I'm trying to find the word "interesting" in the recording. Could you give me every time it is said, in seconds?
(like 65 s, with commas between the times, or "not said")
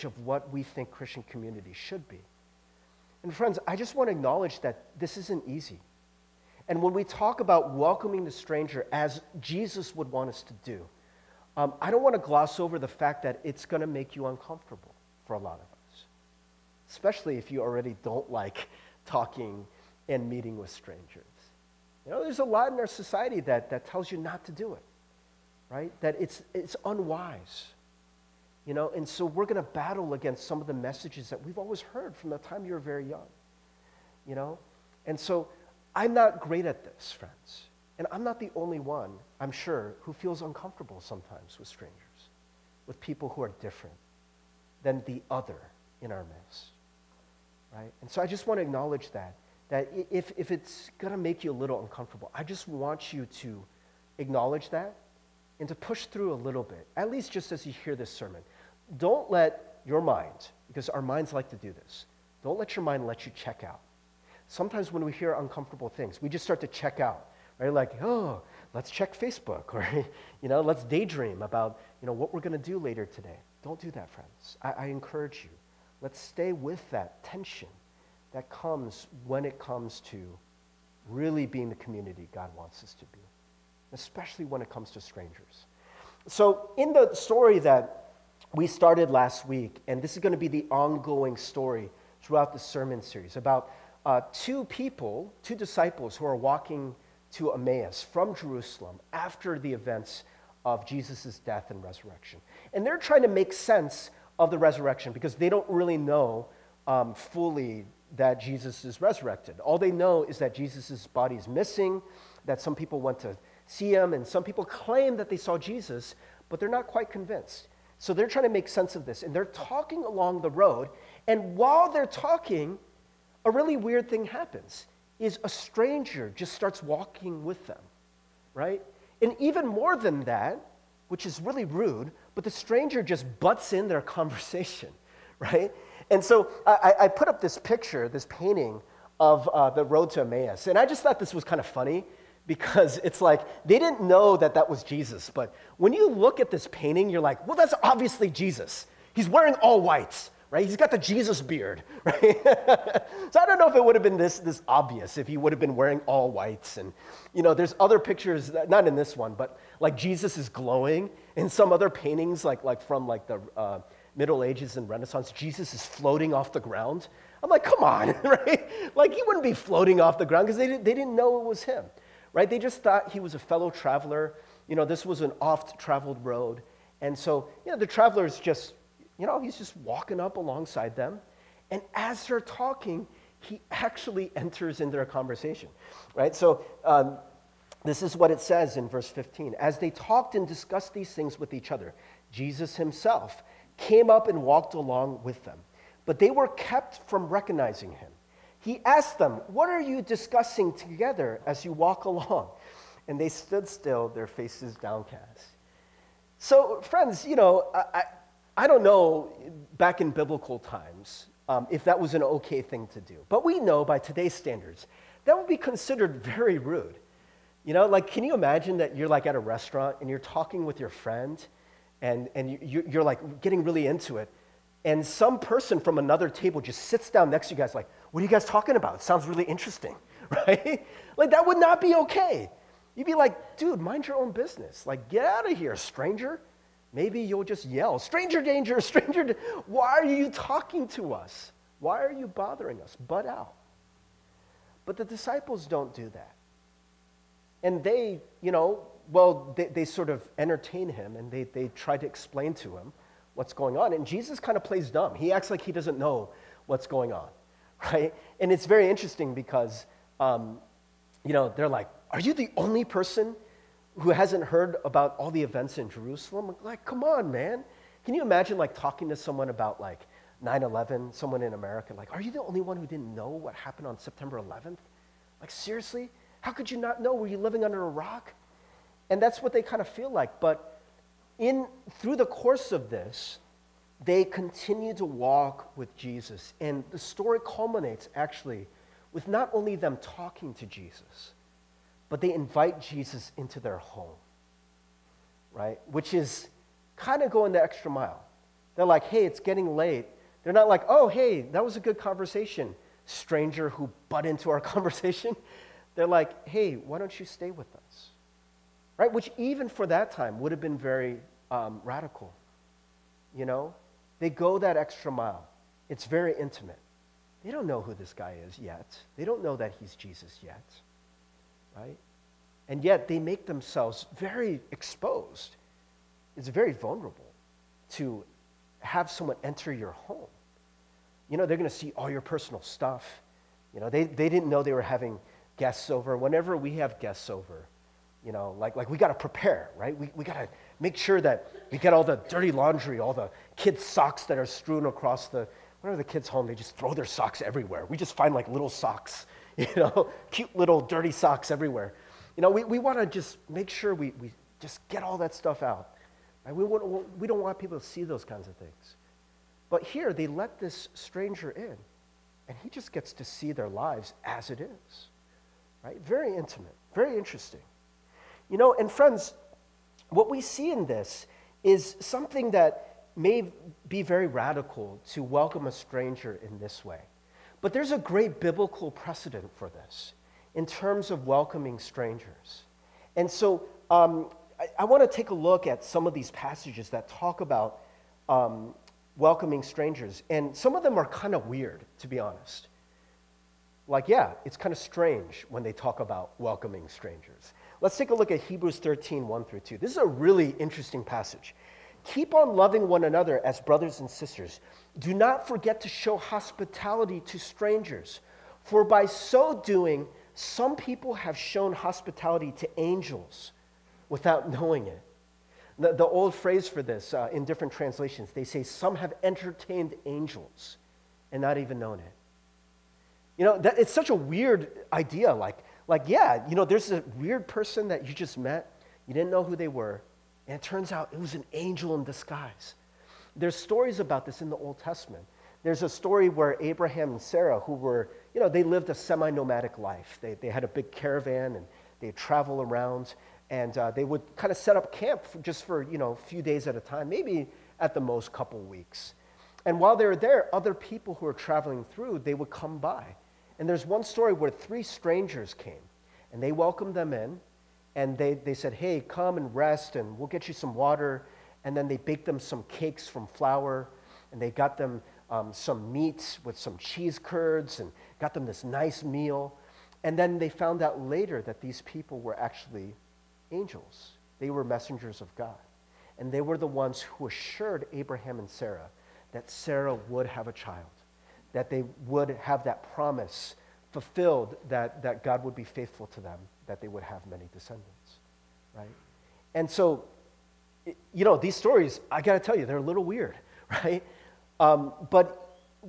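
229 s, 258 s, 367 s, 400 s.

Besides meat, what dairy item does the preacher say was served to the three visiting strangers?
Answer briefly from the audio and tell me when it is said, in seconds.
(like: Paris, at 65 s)
Cheese curds, at 466 s.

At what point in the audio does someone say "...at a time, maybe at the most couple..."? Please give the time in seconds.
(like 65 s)
446 s.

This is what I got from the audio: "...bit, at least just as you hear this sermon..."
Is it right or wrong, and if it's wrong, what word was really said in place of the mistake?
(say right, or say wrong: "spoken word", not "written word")
right.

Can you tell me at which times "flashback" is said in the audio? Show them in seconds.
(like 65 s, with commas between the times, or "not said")
not said.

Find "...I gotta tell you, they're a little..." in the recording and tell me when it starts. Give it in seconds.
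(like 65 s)
492 s.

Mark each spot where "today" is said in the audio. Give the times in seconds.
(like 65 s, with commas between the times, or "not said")
73 s, 213 s.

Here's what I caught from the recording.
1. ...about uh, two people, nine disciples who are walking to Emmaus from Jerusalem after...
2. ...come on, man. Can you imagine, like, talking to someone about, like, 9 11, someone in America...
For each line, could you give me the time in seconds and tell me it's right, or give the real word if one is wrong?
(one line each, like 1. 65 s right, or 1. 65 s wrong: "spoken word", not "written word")
1. 93 s wrong: "two", not "nine"
2. 266 s right.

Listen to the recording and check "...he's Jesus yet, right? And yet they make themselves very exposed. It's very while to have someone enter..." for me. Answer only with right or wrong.
wrong.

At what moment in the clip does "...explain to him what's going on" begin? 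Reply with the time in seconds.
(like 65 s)
252 s.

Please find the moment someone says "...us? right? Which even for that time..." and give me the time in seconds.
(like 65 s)
307 s.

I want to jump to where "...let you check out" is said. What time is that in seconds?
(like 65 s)
63 s.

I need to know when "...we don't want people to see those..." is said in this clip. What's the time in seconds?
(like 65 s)
357 s.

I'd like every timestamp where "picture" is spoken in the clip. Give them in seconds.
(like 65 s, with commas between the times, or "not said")
137 s, 157 s.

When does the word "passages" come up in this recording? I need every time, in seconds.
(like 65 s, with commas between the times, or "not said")
386 s, 401 s.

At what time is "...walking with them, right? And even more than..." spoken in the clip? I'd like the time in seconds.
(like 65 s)
126 s.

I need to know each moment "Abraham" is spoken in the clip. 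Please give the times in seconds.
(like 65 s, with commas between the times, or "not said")
436 s, 477 s.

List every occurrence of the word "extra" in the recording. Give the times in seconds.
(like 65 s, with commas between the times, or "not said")
297 s, 314 s.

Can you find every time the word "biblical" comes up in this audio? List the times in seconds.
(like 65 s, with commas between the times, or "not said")
210 s, 378 s.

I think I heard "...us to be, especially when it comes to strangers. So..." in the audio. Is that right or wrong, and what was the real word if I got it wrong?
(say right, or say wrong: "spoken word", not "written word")
right.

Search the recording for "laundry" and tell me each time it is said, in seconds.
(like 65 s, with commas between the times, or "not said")
342 s.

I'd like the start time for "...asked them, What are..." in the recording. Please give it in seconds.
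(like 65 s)
198 s.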